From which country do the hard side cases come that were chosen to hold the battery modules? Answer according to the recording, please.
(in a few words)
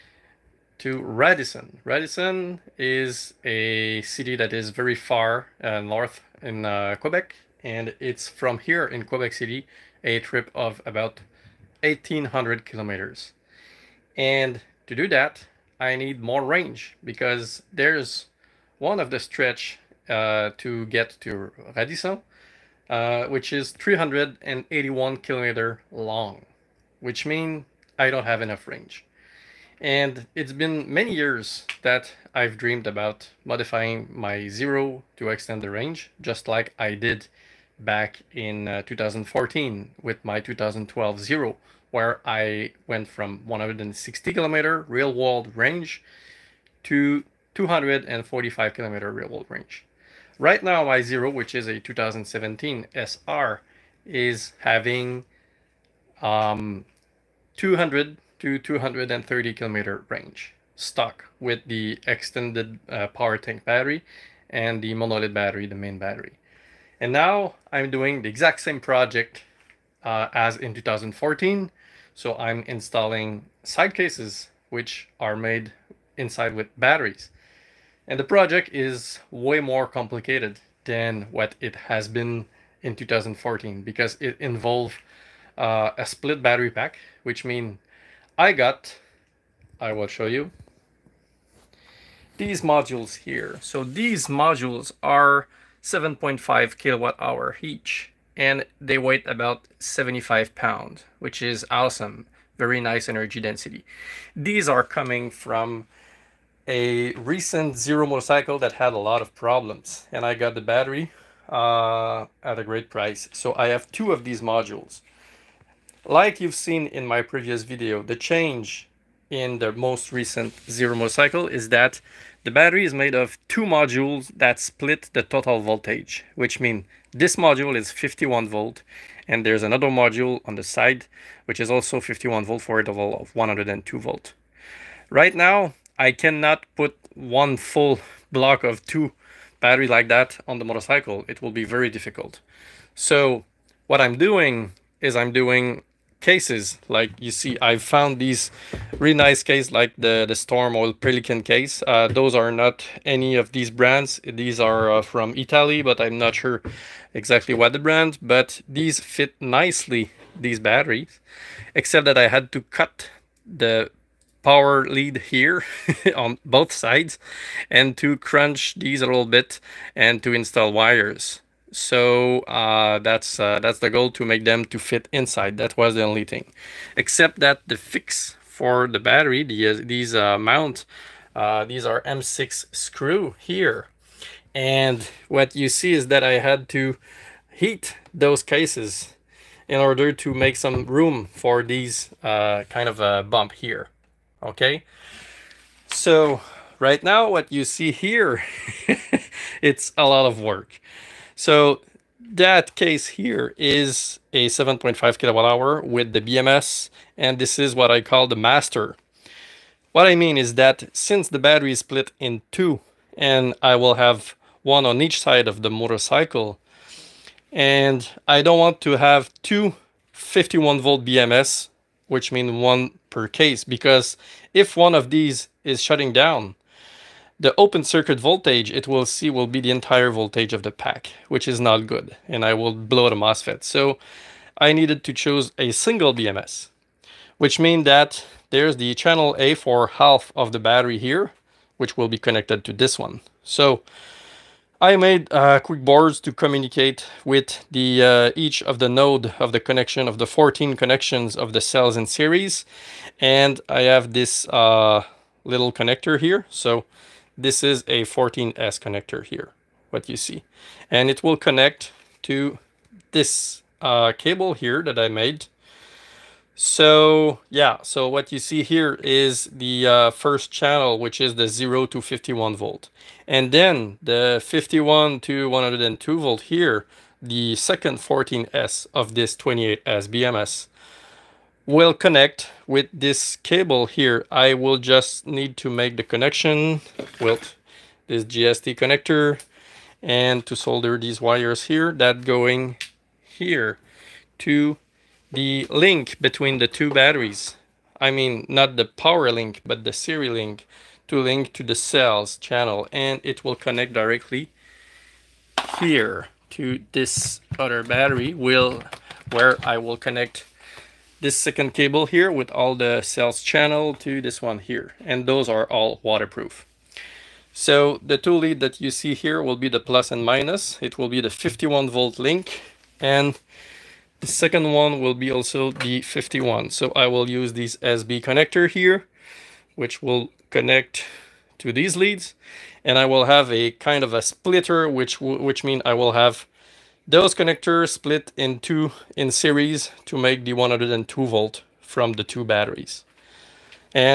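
Italy.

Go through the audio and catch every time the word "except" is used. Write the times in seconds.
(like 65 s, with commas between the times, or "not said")
161 s, 176 s.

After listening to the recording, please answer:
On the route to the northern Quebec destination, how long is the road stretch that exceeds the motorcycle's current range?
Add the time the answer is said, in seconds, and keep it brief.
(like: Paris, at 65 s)
381 kilometers, at 23 s.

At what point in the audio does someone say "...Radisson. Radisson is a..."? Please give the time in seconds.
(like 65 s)
1 s.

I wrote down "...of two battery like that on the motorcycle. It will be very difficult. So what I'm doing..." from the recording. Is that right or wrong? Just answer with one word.
right.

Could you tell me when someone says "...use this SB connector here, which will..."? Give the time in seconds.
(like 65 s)
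327 s.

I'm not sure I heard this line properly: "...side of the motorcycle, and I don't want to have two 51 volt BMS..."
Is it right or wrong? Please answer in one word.
right.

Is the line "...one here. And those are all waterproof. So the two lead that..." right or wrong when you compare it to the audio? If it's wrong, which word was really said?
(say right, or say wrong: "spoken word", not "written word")
right.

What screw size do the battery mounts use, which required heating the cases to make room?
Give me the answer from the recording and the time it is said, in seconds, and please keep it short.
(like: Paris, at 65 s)
M6, at 182 s.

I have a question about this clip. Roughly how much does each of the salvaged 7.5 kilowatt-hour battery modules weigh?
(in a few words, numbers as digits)
75 pounds.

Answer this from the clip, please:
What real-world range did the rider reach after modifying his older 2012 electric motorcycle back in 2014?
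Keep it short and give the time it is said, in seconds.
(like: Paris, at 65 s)
245 kilometers, at 47 s.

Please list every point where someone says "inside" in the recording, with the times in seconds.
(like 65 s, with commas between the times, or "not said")
76 s, 175 s.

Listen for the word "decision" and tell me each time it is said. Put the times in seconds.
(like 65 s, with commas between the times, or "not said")
not said.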